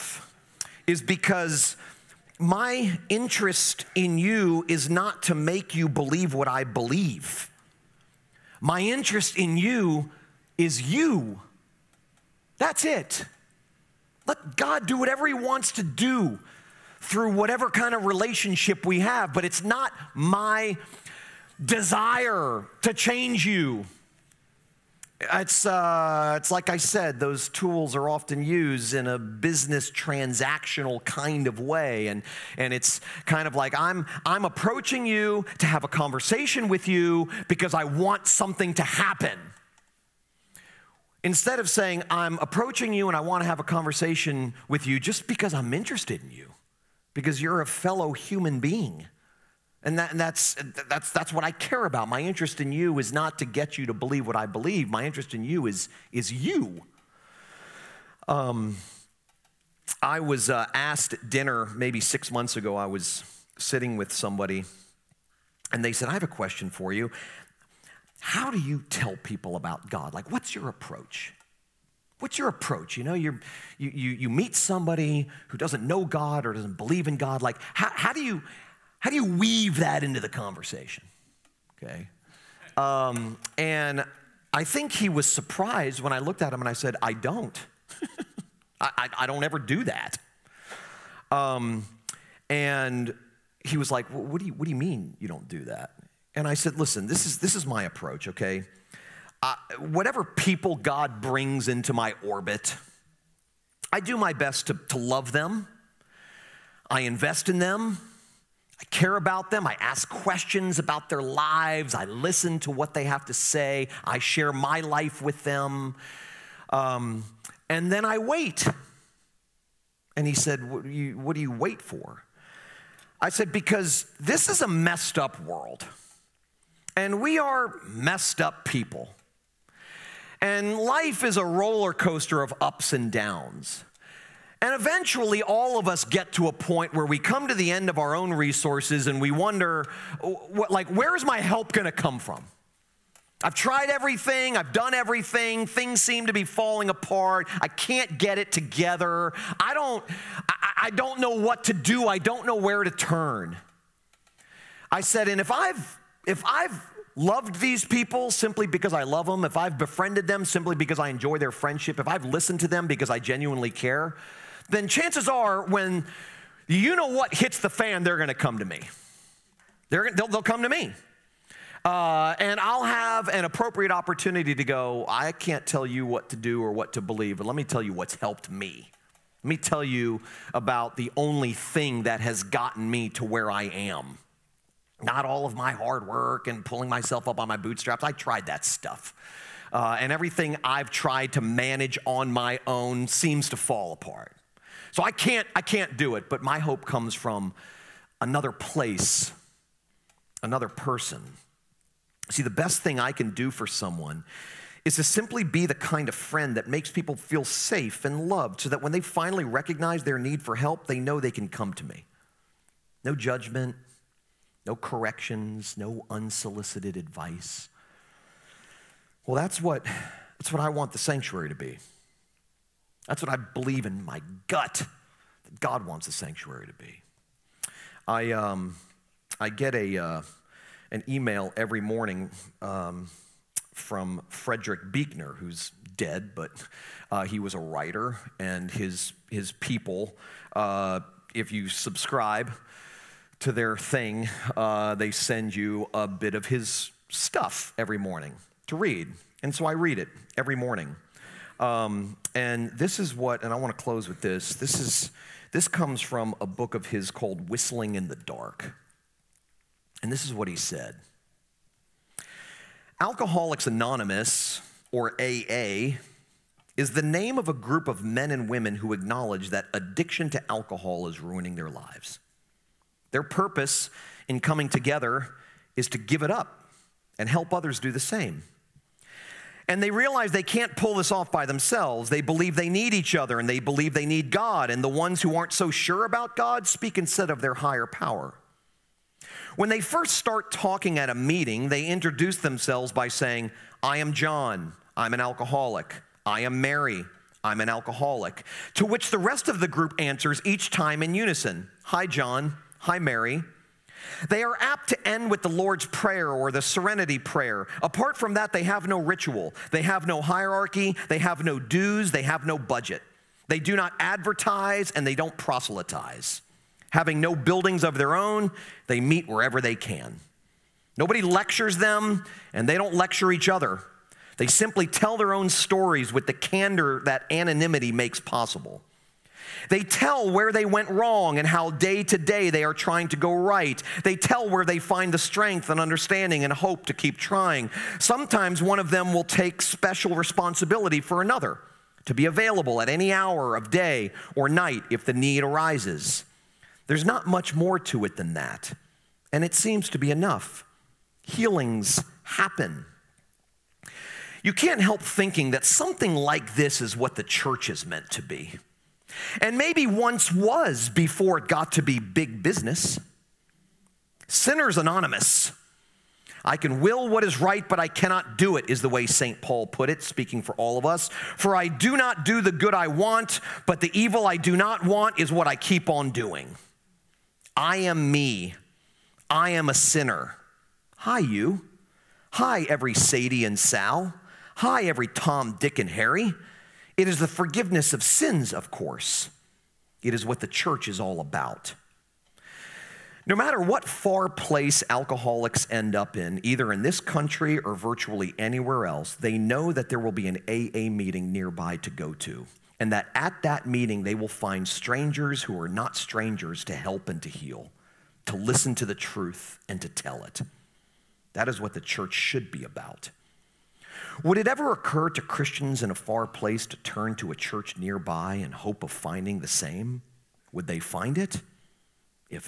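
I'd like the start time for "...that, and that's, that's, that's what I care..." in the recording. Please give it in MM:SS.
00:49.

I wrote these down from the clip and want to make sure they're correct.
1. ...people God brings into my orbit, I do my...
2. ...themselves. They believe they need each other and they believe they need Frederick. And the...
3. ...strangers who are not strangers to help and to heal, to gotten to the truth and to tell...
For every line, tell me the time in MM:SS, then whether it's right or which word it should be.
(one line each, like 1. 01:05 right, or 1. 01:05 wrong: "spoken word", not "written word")
1. 01:40 right
2. 04:41 wrong: "God", not "Frederick"
3. 06:44 wrong: "listen", not "gotten".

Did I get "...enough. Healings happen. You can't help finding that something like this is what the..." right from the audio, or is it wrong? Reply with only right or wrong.
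wrong.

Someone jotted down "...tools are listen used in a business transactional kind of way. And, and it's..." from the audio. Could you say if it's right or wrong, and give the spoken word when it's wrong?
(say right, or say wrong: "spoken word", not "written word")
wrong: "often", not "listen".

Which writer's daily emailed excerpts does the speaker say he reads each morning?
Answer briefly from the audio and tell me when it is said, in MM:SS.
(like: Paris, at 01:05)
Frederick Buechner, at 03:54.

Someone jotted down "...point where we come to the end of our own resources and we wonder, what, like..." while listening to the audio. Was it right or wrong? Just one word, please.
right.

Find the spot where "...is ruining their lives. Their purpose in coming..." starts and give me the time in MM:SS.
04:31.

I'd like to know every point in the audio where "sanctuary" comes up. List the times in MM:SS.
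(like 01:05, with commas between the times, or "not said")
03:40, 03:46.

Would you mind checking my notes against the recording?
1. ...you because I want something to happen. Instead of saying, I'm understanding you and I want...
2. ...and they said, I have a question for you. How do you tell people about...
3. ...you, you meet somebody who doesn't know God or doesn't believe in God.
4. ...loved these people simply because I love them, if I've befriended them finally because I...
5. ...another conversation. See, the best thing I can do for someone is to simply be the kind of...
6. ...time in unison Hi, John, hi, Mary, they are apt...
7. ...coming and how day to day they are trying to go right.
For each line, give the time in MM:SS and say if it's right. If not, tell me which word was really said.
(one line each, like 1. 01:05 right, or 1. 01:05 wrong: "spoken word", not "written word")
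1. 00:36 wrong: "approaching", not "understanding"
2. 01:05 right
3. 01:13 right
4. 02:37 wrong: "simply", not "finally"
5. 03:20 wrong: "person", not "conversation"
6. 05:00 right
7. 05:30 wrong: "wrong", not "coming".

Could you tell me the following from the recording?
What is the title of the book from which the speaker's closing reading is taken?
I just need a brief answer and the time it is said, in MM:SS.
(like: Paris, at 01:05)
Whistling in the Dark, at 04:17.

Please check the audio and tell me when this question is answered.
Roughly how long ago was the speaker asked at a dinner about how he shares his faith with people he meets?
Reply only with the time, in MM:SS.
01:02.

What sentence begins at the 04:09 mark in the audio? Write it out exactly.
And so I read it every morning.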